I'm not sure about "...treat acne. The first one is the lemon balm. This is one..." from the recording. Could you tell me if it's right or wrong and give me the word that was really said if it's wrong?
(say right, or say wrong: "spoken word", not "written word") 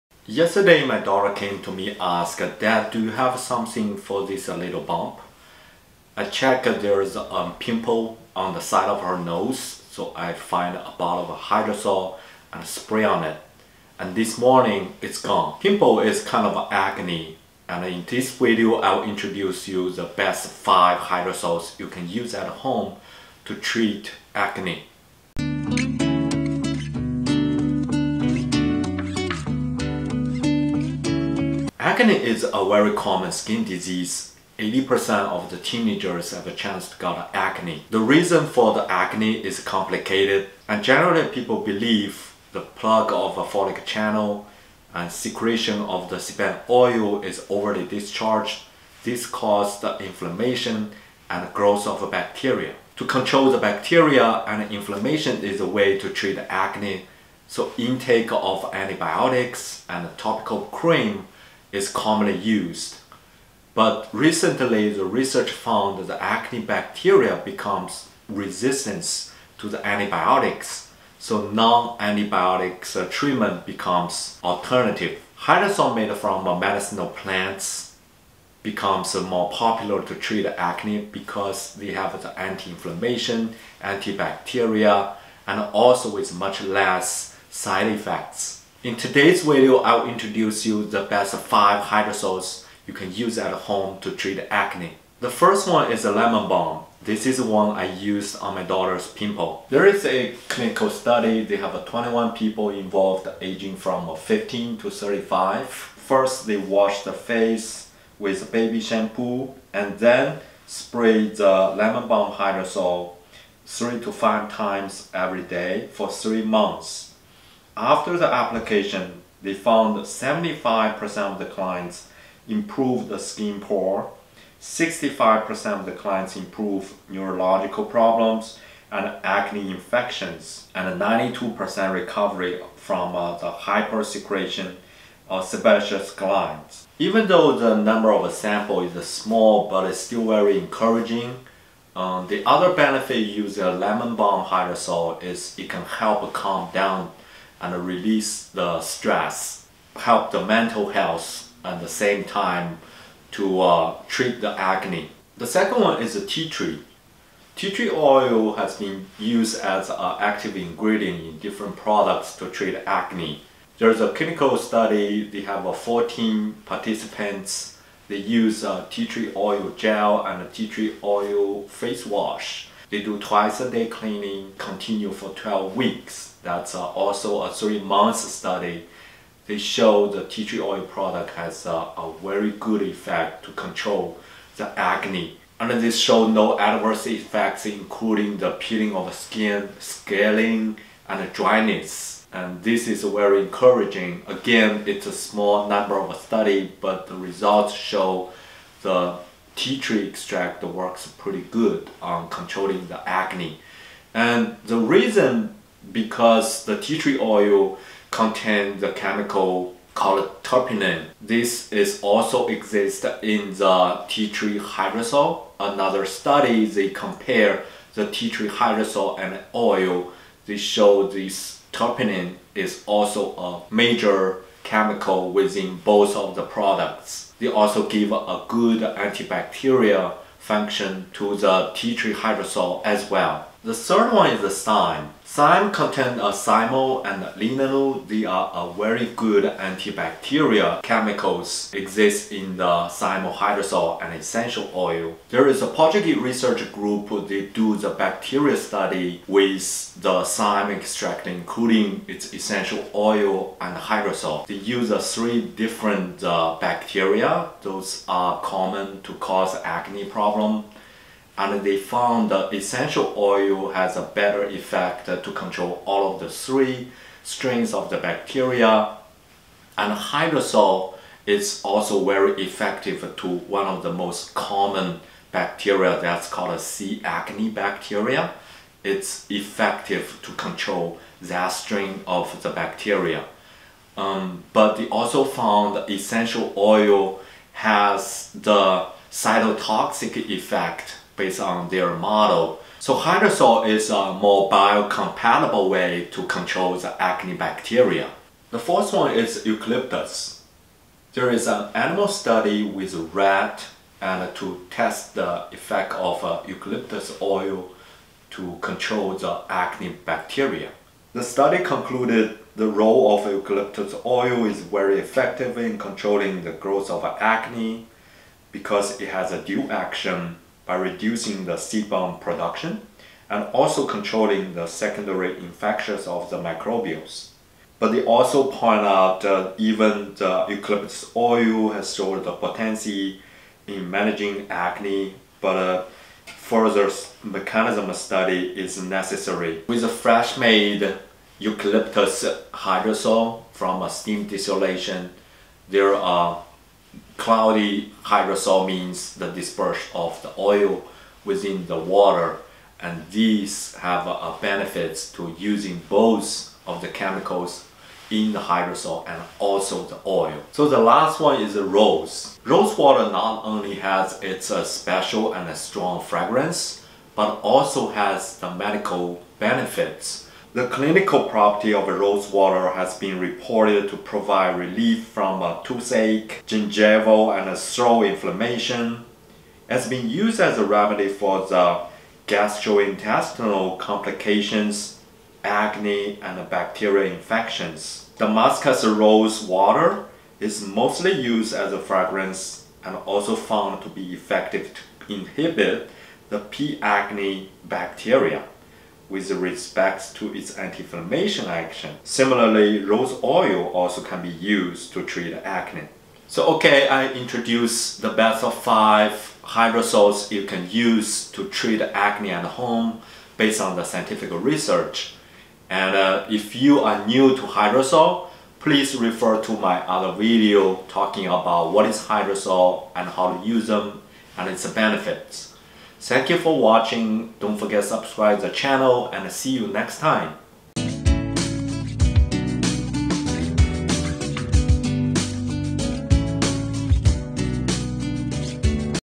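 right.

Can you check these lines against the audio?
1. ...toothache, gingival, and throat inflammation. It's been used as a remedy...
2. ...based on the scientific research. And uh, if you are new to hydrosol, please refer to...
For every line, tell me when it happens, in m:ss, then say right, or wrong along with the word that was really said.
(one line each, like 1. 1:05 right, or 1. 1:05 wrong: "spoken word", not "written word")
1. 6:15 right
2. 6:53 right.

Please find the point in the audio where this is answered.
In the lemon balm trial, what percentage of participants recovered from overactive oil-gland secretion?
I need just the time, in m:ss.
2:10.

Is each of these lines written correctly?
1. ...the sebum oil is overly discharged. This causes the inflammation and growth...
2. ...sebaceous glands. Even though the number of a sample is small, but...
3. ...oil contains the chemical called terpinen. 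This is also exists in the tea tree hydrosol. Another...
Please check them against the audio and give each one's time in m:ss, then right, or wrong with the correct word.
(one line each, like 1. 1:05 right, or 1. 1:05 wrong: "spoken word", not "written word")
1. 0:46 right
2. 2:15 right
3. 3:27 right.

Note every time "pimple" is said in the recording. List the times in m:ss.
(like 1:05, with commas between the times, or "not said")
0:07, 0:15, 1:39.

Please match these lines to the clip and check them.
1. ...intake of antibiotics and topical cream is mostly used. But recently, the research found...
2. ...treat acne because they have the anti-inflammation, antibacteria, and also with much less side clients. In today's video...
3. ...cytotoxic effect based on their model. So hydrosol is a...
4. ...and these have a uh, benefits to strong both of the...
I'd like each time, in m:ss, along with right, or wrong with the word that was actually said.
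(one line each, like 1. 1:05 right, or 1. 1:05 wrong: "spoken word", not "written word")
1. 0:57 wrong: "commonly", not "mostly"
2. 1:20 wrong: "effects", not "clients"
3. 4:49 right
4. 5:52 wrong: "using", not "strong".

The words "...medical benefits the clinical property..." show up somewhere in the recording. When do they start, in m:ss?
6:08.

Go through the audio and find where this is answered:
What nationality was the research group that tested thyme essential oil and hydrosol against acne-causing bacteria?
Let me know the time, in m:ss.
4:05.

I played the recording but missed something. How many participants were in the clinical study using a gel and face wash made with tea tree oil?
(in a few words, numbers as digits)
14.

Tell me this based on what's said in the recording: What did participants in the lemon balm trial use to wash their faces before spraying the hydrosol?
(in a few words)
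baby shampoo.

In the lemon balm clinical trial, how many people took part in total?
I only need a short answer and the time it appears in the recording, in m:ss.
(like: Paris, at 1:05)
21, at 1:41.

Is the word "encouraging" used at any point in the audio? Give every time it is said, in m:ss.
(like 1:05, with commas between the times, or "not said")
2:20, 3:13.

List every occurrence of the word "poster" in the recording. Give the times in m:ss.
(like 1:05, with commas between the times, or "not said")
not said.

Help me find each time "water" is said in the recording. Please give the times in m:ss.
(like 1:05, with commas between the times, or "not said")
5:51, 6:02, 6:12, 6:29.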